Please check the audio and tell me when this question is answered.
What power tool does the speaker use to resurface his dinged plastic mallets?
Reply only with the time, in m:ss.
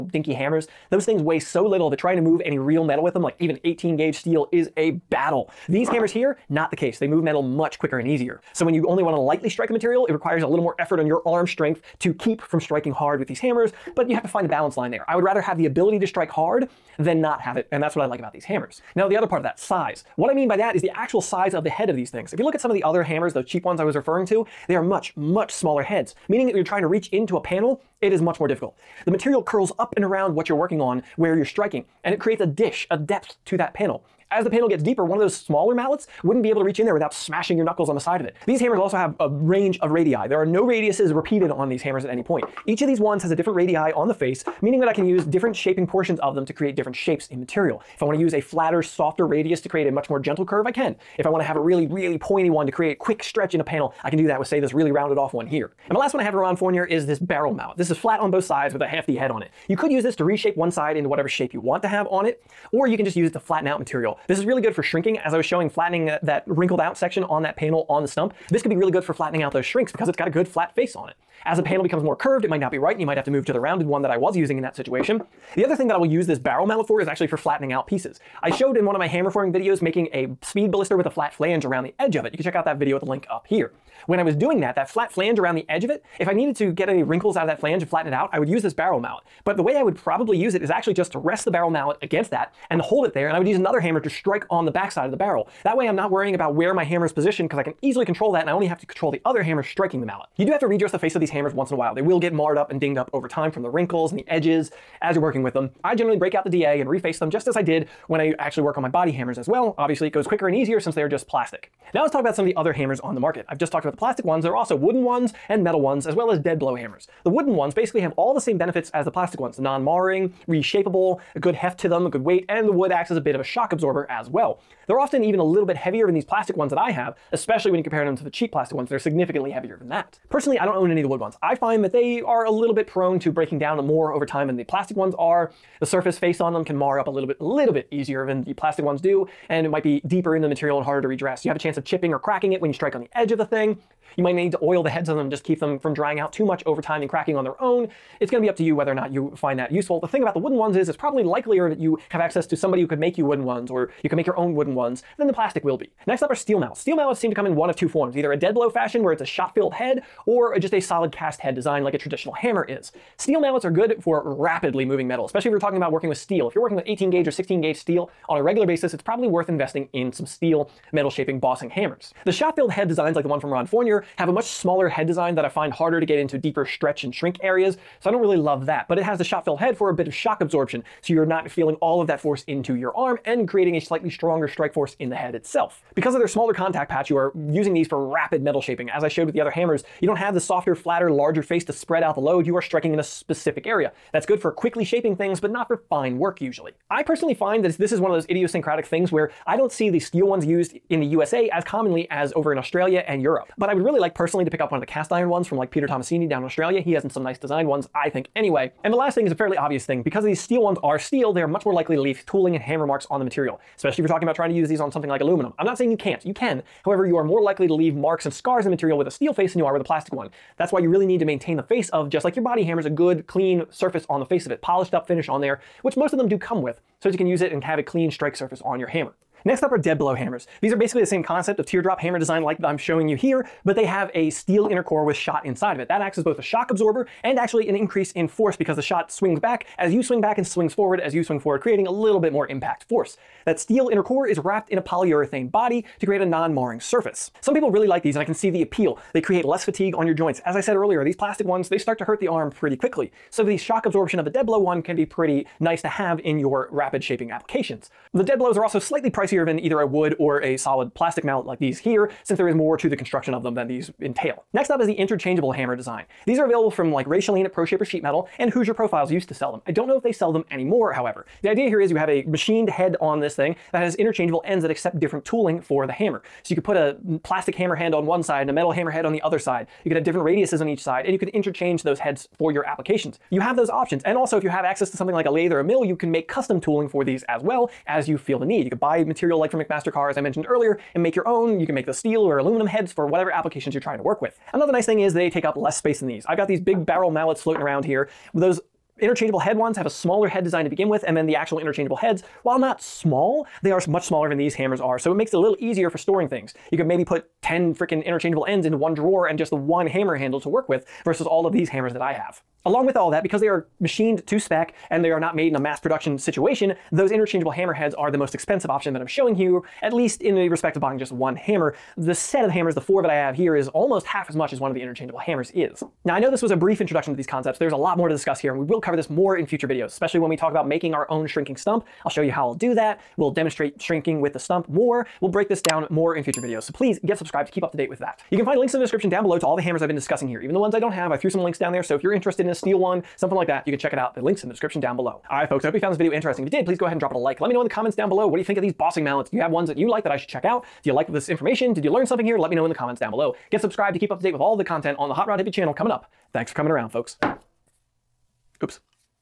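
1:46.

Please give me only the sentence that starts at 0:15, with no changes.
I would rather have the ability to strike hard than not have it.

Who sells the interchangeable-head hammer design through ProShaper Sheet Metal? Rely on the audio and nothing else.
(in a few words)
Wray Schelin.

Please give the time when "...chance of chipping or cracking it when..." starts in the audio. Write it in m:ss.
2:21.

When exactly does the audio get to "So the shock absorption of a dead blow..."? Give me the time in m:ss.
4:13.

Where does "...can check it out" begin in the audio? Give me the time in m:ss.
5:43.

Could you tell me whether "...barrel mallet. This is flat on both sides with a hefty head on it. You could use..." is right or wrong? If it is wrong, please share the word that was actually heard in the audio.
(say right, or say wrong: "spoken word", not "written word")
right.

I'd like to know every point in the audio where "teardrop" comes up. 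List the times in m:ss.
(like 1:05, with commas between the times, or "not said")
3:51.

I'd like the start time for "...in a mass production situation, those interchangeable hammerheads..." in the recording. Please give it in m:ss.
5:15.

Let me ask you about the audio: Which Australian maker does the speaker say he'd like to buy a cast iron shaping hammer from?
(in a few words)
Peter Tommasini.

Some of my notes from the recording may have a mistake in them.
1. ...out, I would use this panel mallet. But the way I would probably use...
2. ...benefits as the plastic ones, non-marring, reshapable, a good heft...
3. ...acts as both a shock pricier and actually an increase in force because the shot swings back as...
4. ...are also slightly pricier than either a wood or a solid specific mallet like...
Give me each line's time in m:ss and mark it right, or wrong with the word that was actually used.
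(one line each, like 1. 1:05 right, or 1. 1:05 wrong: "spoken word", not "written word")
1. 1:28 wrong: "barrel", not "panel"
2. 1:58 right
3. 3:56 wrong: "absorber", not "pricier"
4. 4:18 wrong: "plastic", not "specific".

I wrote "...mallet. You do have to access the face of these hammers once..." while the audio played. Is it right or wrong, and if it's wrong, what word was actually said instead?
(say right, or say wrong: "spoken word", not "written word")
wrong: "redress", not "access".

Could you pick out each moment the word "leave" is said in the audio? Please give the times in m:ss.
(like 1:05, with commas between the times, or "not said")
3:32, 3:37.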